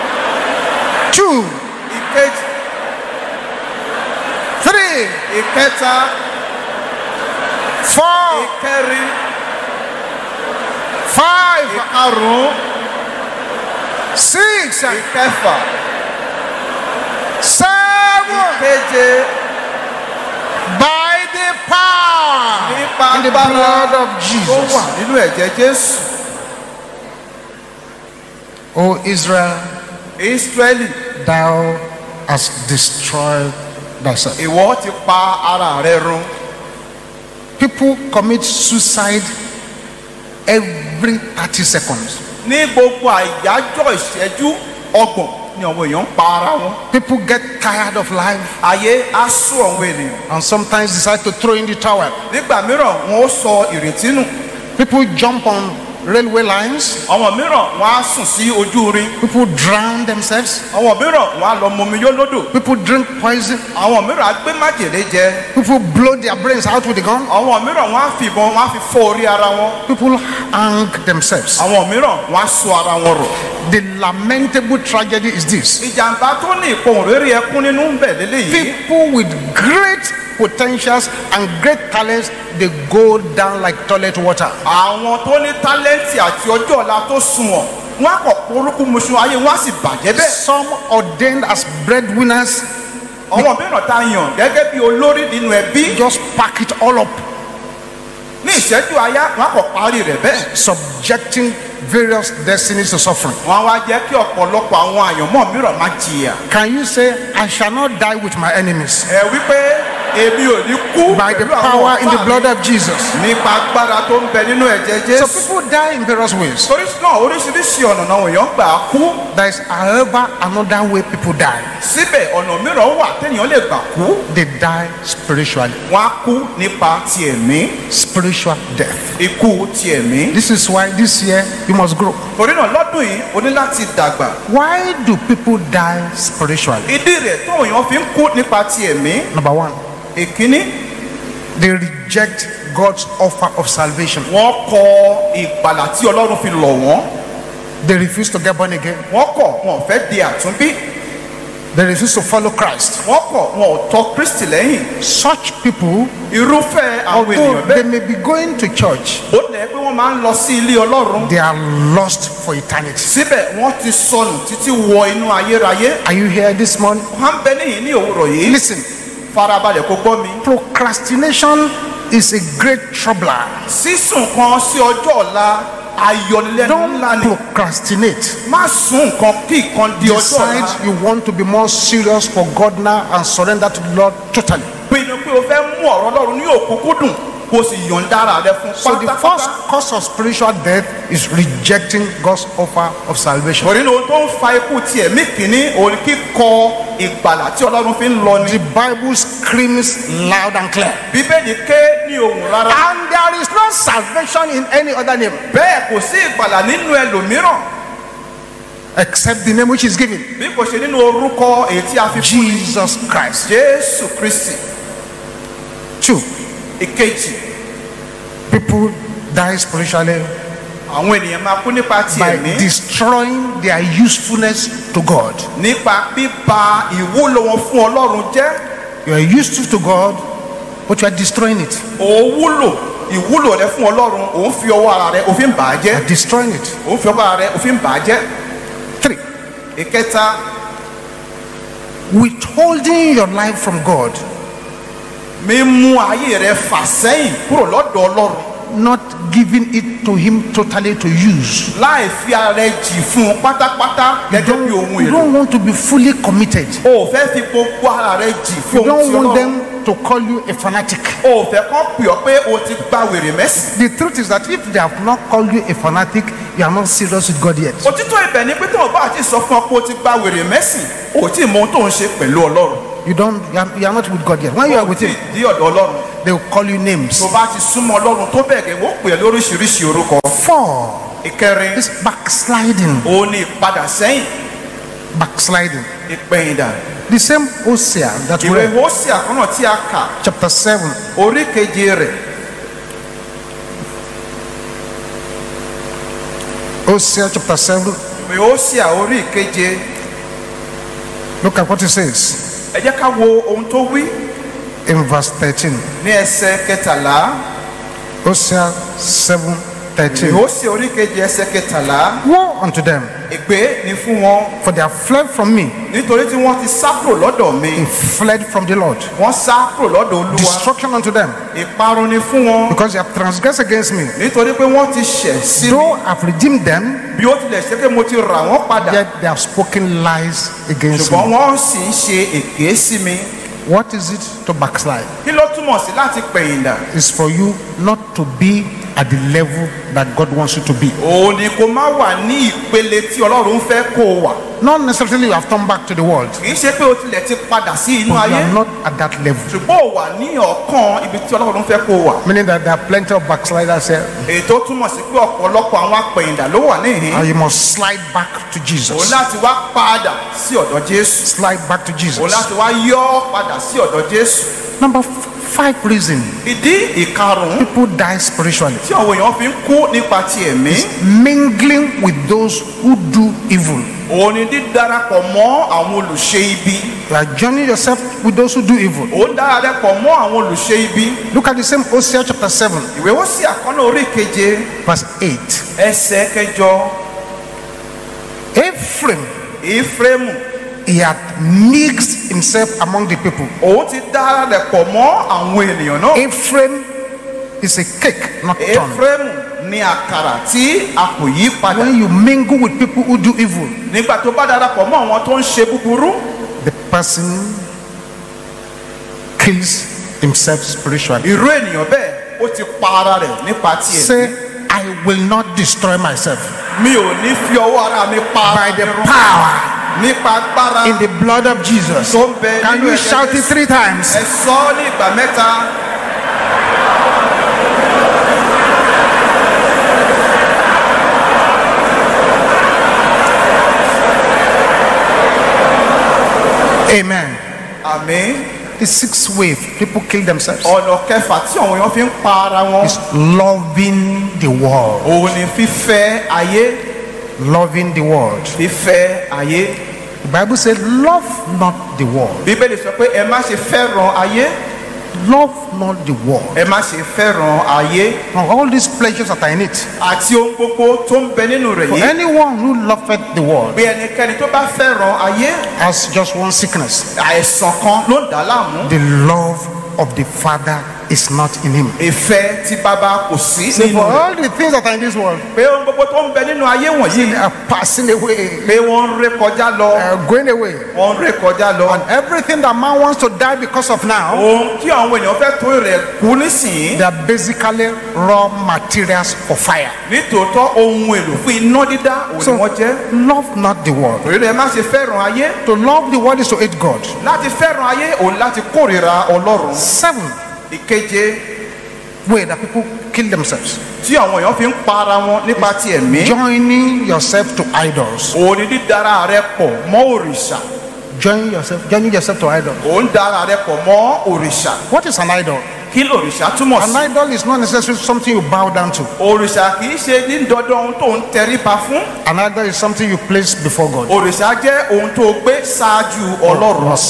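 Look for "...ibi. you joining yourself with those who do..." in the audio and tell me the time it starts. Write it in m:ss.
6:16.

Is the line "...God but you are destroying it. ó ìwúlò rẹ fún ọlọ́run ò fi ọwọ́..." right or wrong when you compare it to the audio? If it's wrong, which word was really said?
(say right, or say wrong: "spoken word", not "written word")
right.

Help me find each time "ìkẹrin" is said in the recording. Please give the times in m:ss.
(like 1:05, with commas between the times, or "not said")
0:08, 4:41.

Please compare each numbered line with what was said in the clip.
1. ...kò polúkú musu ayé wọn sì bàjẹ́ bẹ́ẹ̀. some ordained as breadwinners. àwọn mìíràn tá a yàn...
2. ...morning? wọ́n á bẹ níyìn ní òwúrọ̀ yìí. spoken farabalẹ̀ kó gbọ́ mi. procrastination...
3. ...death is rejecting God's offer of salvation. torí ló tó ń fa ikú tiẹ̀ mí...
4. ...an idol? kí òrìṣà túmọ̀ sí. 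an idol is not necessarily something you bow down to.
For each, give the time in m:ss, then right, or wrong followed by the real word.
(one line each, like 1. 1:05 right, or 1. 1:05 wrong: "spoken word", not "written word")
1. 1:28 right
2. 2:46 wrong: "listen", not "spoken"
3. 3:10 right
4. 8:35 right.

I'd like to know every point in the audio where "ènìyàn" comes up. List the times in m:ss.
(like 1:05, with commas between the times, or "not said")
0:49, 2:37, 3:41, 6:35, 6:51.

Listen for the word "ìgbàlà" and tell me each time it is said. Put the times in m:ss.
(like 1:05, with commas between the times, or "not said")
2:25, 3:17, 3:26.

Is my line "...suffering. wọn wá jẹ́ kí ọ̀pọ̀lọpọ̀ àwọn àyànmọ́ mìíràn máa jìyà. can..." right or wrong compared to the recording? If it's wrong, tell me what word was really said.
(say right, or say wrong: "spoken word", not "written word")
right.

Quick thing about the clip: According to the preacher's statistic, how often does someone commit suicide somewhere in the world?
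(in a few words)
every 30 seconds.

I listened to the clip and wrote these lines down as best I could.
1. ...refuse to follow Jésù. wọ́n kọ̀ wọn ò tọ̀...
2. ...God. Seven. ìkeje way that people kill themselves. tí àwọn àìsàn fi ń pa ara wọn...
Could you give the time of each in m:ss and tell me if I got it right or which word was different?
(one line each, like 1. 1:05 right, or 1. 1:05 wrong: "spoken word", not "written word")
1. 2:31 wrong: "Christ", not "Jésù"
2. 8:16 wrong: "èèyàn", not "àìsàn".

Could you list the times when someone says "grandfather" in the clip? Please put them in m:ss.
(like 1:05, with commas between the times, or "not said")
not said.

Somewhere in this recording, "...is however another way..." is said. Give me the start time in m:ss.
1:59.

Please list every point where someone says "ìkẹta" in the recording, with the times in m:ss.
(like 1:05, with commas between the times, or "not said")
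0:05, 3:59.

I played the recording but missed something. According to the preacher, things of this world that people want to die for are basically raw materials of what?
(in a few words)
fire.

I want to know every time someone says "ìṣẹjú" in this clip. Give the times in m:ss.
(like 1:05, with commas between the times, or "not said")
0:43, 1:38.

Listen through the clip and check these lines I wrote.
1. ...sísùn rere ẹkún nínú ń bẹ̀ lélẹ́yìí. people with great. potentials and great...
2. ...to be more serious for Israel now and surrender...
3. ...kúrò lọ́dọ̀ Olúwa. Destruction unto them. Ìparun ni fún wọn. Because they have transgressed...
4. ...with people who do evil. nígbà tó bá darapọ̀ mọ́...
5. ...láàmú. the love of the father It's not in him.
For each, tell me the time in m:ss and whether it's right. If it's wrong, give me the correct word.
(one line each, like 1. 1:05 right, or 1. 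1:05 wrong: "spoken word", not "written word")
1. 1:16 wrong: "ìpohùn", not "sísùn"
2. 3:01 wrong: "God", not "Israel"
3. 5:19 right
4. 6:42 right
5. 7:48 right.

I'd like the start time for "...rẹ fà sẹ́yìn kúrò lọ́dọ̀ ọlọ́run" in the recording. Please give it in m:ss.
4:06.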